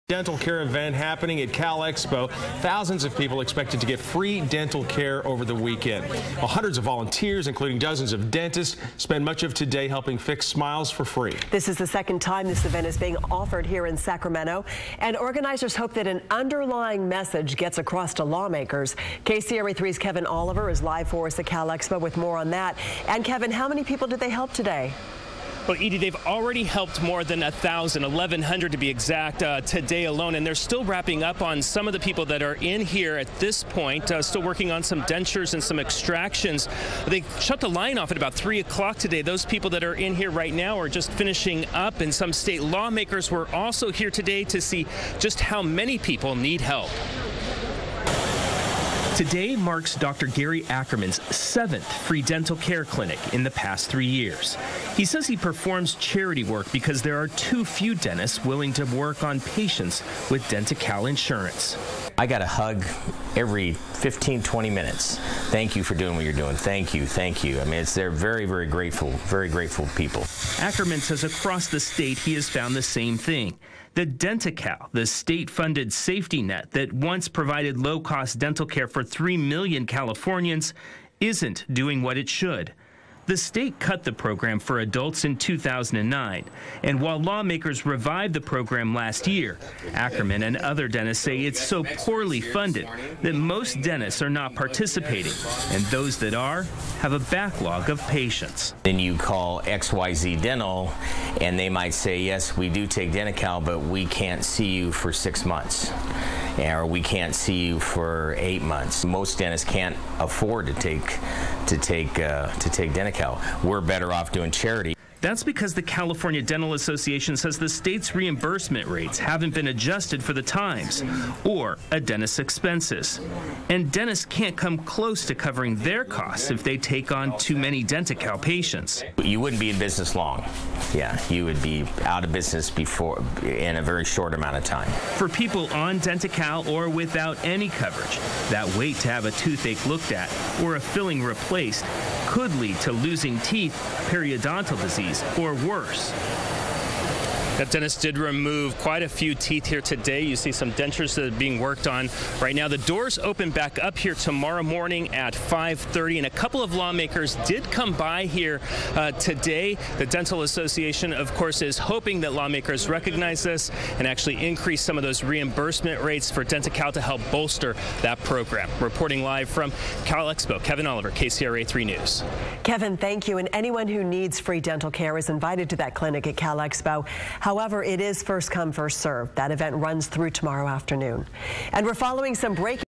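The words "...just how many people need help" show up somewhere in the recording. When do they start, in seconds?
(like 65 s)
45 s.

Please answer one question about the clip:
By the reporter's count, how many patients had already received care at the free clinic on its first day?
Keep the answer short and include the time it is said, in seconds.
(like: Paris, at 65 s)
1,100, at 28 s.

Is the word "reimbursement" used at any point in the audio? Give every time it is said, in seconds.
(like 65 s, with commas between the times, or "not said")
118 s, 165 s.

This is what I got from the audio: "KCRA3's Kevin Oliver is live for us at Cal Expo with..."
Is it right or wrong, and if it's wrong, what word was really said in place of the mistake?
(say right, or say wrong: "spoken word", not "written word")
right.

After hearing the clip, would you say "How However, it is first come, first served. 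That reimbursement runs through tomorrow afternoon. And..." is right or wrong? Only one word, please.
wrong.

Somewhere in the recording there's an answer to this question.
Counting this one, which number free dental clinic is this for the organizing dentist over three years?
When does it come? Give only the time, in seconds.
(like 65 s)
51 s.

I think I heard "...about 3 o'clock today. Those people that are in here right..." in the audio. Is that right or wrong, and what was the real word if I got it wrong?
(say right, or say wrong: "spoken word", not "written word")
right.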